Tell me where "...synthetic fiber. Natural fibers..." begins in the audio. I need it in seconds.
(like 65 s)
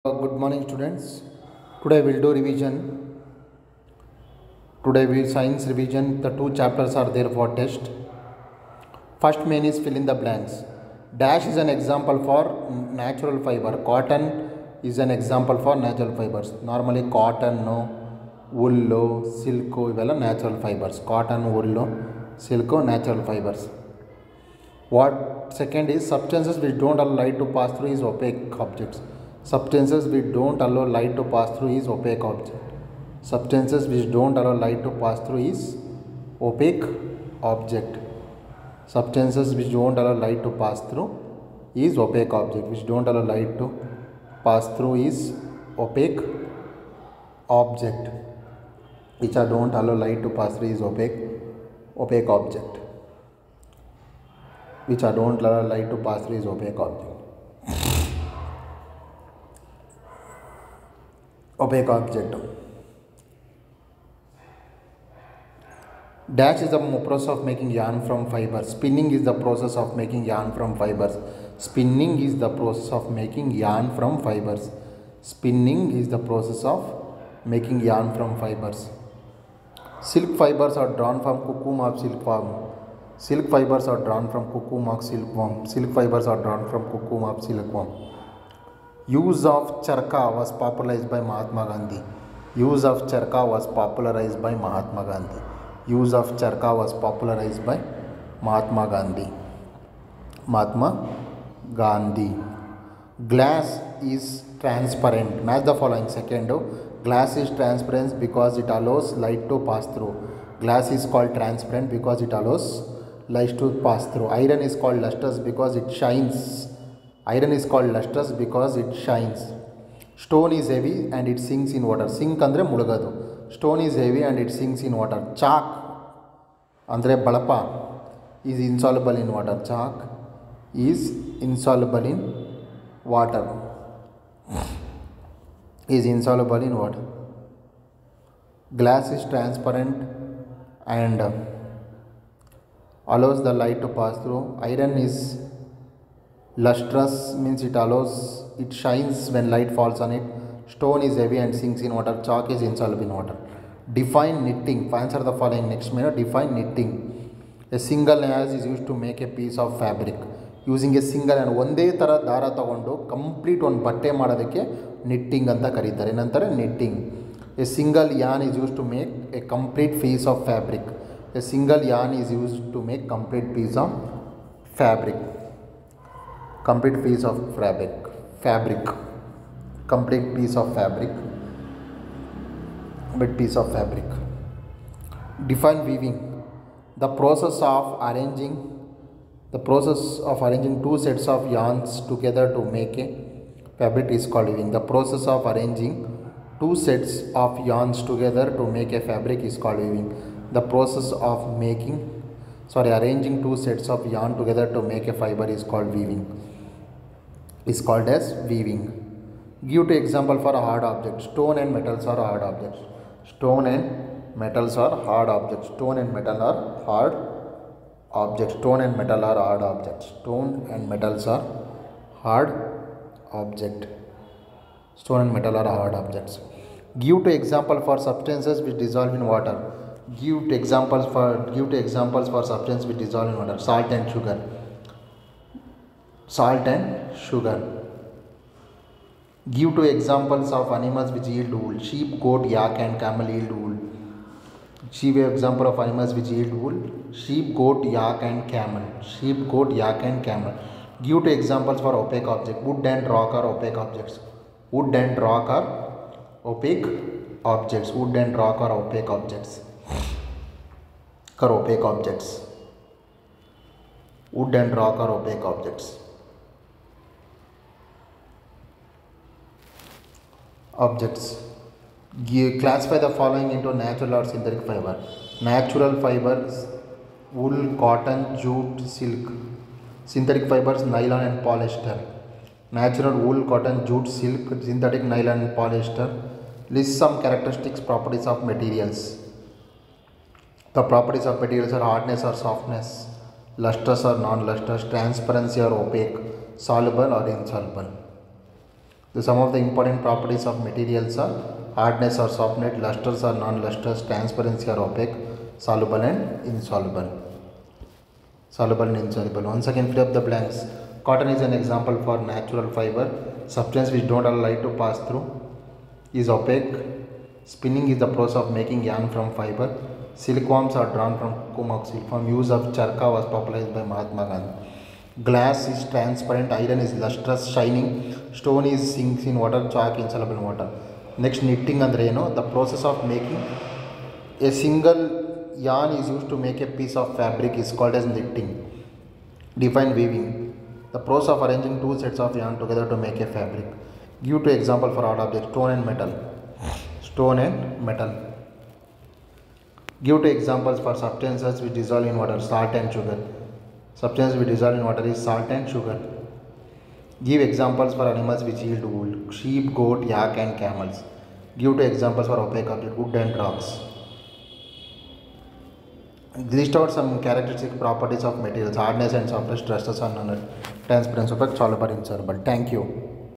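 274 s.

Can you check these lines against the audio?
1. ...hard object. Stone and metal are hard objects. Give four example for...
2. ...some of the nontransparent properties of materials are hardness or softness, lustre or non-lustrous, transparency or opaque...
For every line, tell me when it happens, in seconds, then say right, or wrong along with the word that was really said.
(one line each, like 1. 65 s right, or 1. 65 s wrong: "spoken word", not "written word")
1. 222 s wrong: "two", not "four"
2. 299 s wrong: "important", not "nontransparent".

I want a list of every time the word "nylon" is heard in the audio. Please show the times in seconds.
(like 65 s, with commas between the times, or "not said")
280 s, 285 s.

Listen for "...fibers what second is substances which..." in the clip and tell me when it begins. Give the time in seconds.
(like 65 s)
23 s.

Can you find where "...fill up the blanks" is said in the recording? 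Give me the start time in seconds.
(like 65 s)
309 s.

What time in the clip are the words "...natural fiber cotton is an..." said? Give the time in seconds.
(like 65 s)
13 s.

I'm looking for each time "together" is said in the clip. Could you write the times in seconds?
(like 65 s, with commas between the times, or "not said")
192 s, 198 s, 204 s, 342 s.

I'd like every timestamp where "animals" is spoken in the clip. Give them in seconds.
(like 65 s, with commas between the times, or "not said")
240 s, 245 s, 358 s.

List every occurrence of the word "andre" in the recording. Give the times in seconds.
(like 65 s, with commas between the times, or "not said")
122 s, 126 s.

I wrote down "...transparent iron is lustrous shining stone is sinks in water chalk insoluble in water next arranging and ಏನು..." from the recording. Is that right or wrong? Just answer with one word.
wrong.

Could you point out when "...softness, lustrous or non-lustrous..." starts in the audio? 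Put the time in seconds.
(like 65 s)
292 s.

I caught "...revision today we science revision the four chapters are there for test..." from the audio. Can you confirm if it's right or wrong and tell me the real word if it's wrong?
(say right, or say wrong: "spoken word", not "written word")
wrong: "two", not "four".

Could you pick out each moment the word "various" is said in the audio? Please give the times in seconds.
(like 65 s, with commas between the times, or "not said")
not said.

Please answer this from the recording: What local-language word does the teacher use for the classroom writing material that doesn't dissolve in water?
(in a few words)
balapa.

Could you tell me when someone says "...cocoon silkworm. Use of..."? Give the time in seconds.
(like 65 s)
321 s.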